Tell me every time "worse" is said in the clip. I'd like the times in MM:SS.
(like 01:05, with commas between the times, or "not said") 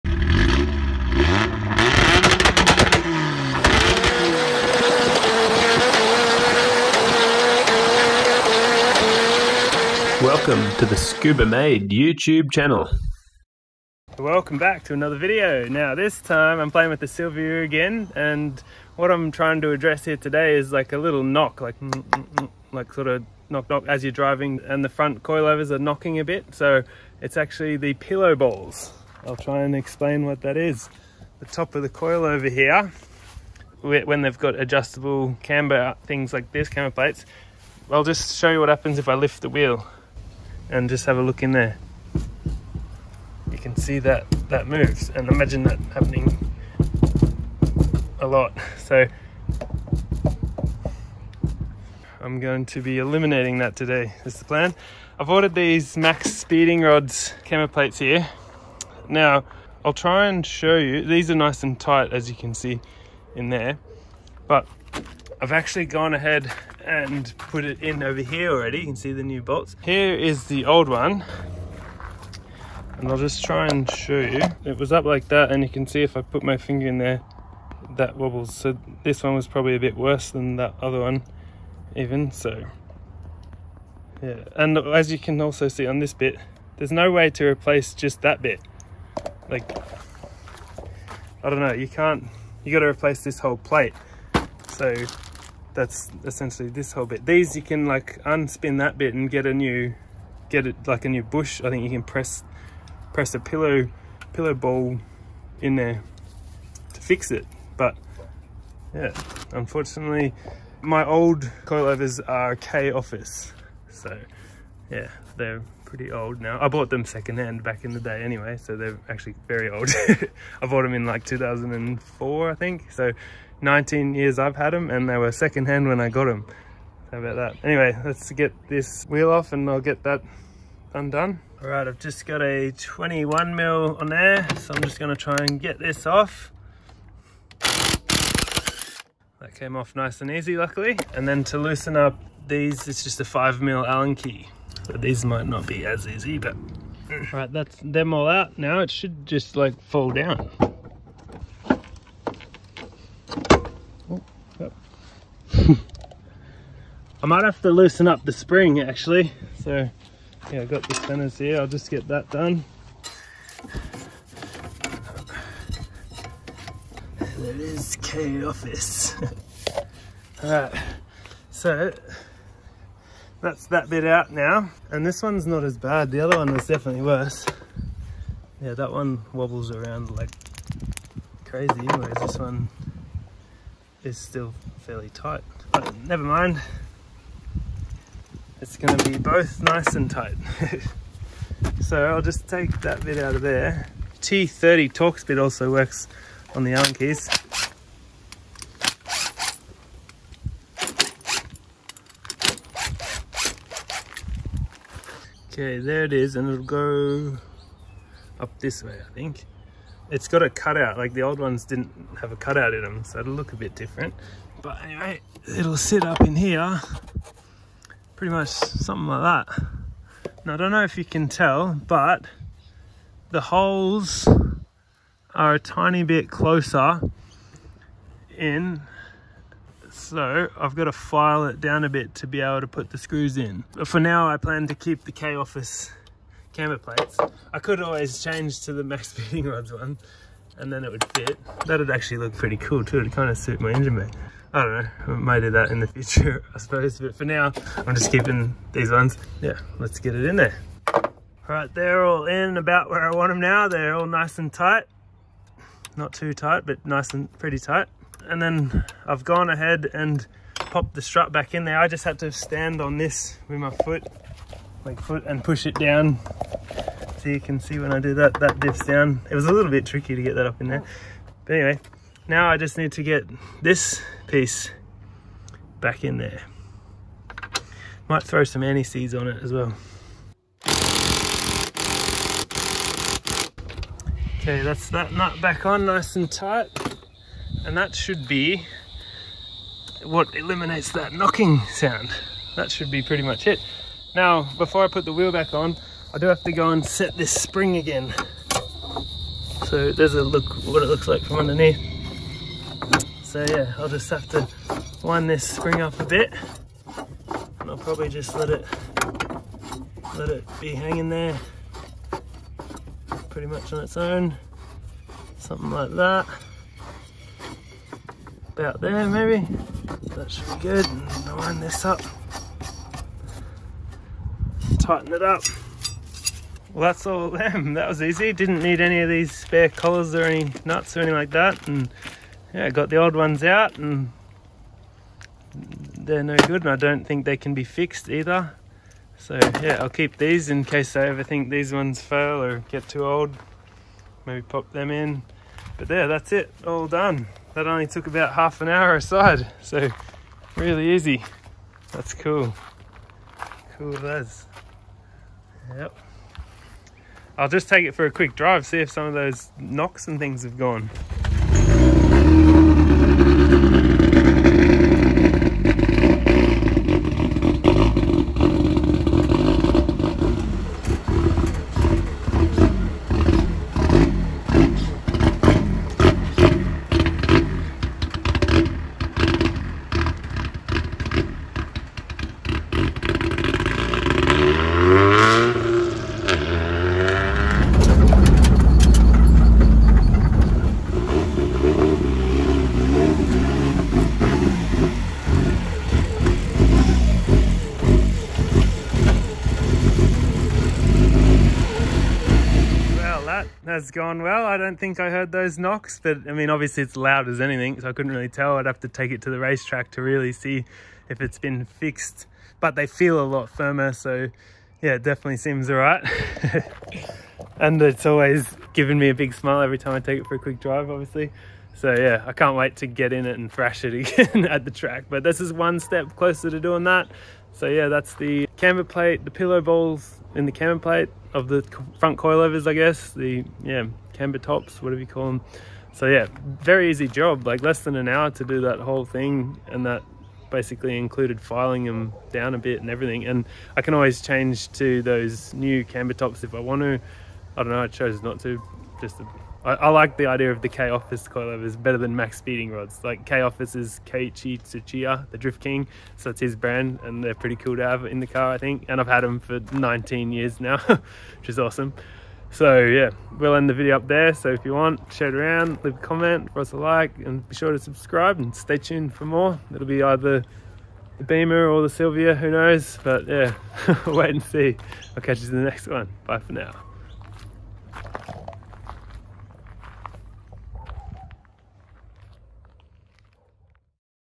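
01:19, 02:57.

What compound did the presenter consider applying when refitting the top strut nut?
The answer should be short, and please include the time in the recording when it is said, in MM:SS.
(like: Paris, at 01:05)
anti-seize, at 04:38.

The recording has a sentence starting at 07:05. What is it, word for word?
But this is one step closer to doing that.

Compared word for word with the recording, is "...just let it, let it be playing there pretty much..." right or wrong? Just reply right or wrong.
wrong.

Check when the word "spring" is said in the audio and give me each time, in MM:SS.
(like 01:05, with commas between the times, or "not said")
02:38, 04:57, 05:05.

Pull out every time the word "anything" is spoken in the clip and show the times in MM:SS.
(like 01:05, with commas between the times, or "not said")
05:30, 06:47.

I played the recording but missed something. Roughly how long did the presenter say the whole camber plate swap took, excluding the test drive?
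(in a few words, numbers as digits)
half an hour.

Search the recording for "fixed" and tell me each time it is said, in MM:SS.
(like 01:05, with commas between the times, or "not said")
05:37, 06:51.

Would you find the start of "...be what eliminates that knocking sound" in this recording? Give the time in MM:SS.
04:48.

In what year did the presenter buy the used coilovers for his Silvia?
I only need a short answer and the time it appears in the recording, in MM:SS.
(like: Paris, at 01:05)
2004, at 02:01.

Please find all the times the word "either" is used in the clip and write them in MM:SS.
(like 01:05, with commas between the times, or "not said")
05:38, 07:50.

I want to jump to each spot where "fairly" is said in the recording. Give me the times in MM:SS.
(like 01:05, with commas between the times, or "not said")
03:04.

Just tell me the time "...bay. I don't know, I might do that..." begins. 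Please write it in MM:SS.
04:03.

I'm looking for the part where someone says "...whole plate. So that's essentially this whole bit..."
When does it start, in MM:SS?
01:33.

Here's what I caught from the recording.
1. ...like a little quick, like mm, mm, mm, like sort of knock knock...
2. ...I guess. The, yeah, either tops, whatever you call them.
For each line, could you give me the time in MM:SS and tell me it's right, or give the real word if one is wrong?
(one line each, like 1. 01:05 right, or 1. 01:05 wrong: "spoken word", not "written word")
1. 00:20 wrong: "knock", not "quick"
2. 07:12 wrong: "camber", not "either".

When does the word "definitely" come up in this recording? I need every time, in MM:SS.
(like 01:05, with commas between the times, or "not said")
02:56, 06:55.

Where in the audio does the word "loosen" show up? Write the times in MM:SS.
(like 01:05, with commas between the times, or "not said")
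02:21, 02:37.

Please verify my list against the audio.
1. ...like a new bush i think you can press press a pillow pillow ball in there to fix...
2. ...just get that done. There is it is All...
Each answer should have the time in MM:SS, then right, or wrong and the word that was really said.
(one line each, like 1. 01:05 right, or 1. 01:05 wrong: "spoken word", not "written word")
1. 01:40 right
2. 02:41 wrong: "Kei", not "All".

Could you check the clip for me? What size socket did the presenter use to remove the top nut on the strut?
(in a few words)
21 mm.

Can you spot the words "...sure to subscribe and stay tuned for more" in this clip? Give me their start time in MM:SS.
07:47.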